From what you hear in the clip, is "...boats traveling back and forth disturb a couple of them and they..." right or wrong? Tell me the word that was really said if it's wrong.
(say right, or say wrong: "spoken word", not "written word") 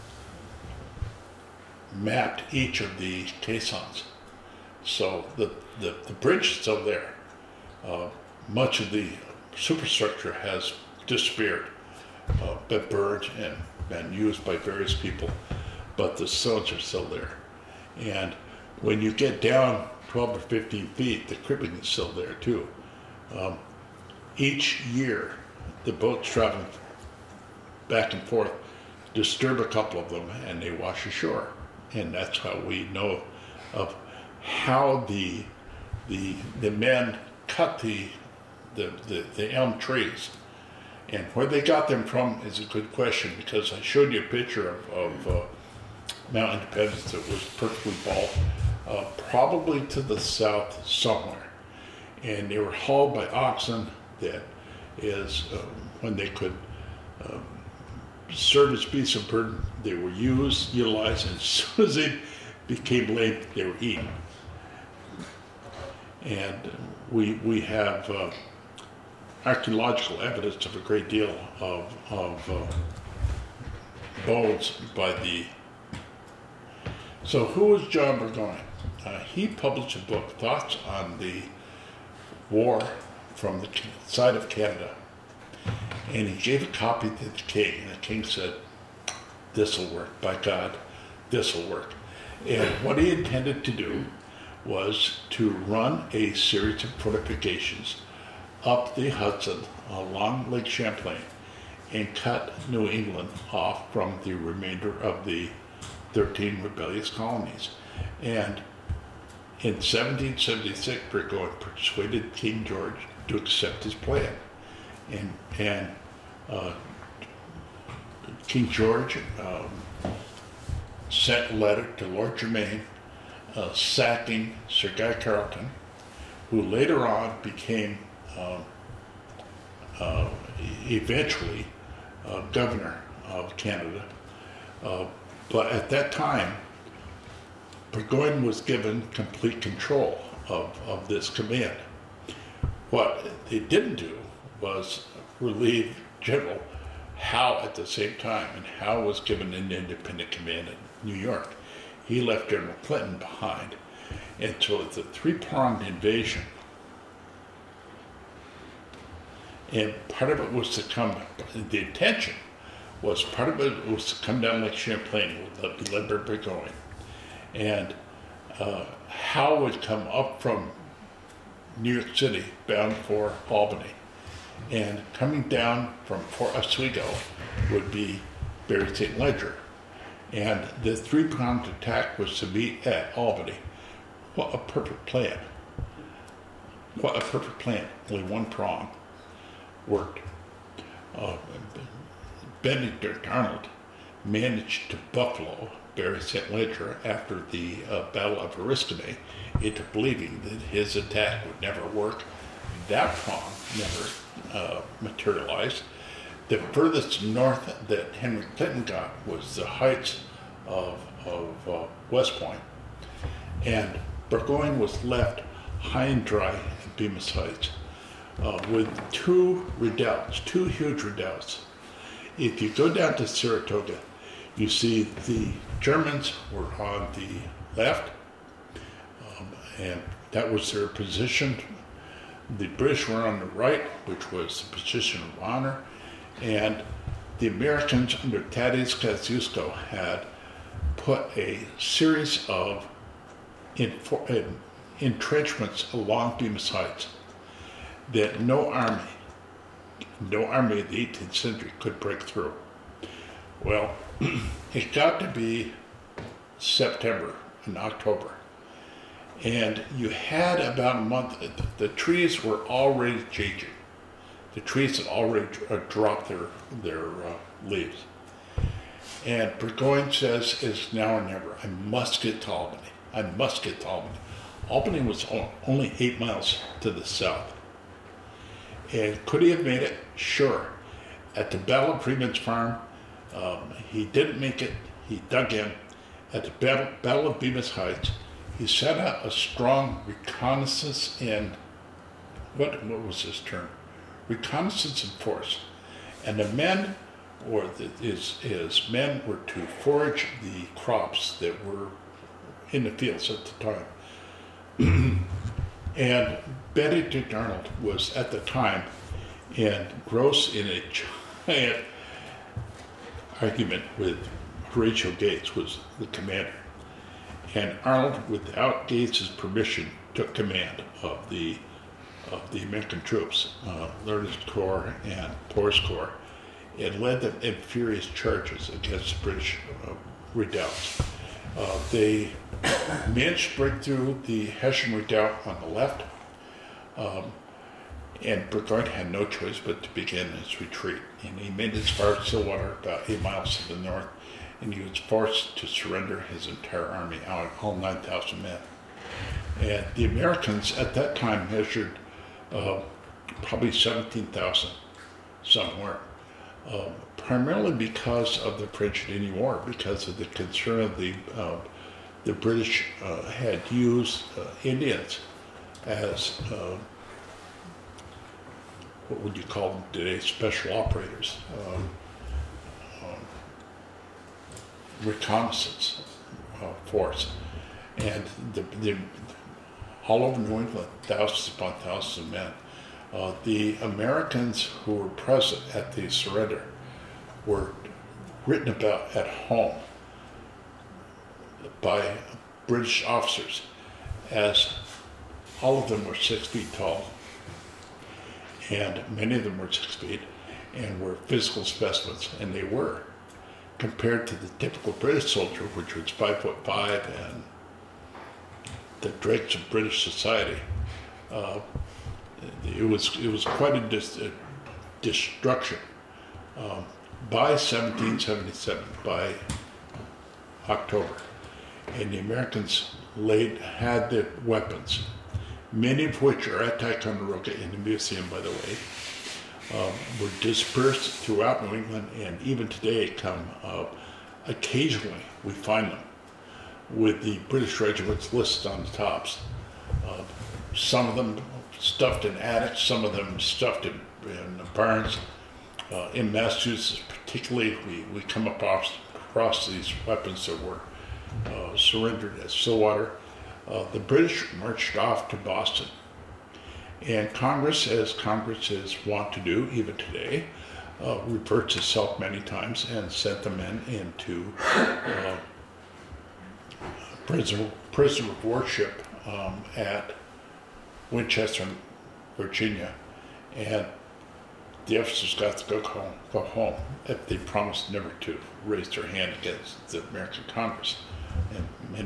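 right.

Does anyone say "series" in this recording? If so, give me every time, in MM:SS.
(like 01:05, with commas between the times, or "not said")
01:36, 04:01.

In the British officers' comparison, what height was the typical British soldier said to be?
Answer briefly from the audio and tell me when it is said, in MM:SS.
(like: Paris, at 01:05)
five foot five, at 06:46.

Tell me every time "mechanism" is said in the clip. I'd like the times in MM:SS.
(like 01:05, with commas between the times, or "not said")
not said.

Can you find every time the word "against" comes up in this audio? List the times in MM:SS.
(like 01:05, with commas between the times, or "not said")
05:28, 07:59.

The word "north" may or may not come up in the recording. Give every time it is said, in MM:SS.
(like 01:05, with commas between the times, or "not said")
03:27, 05:43.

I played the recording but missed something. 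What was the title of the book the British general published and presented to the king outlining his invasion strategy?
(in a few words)
Thoughts on the War from the Side of Canada.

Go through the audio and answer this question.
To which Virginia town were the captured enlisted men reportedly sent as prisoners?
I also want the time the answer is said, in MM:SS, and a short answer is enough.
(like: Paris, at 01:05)
Winchester, at 07:51.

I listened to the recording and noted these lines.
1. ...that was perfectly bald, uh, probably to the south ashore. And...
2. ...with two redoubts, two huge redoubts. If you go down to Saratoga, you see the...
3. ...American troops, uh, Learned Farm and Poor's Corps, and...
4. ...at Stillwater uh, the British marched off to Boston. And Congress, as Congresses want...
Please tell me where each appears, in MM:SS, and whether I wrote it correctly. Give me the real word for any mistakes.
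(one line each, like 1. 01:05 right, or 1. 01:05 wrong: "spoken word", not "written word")
1. 00:47 wrong: "somewhere", not "ashore"
2. 03:38 right
3. 05:22 wrong: "Corps", not "Farm"
4. 07:32 right.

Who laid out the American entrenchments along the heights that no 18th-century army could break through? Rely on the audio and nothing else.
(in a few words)
Tadeusz Kosciuszko.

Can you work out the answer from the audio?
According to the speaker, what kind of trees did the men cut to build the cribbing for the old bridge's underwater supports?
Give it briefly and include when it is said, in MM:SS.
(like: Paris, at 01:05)
elm, at 00:39.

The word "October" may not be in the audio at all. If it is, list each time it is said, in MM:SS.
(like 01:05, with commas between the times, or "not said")
04:17, 07:00.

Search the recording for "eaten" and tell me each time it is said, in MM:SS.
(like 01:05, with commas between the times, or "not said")
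01:03.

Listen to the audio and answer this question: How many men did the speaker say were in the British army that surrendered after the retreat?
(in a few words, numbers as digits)
9,000.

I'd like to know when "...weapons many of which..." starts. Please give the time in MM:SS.
07:04.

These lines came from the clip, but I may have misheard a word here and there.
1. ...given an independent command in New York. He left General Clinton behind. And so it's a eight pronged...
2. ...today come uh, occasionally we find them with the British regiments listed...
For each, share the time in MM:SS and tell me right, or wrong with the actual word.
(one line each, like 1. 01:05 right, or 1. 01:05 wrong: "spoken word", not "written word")
1. 02:29 wrong: "three", not "eight"
2. 07:12 right.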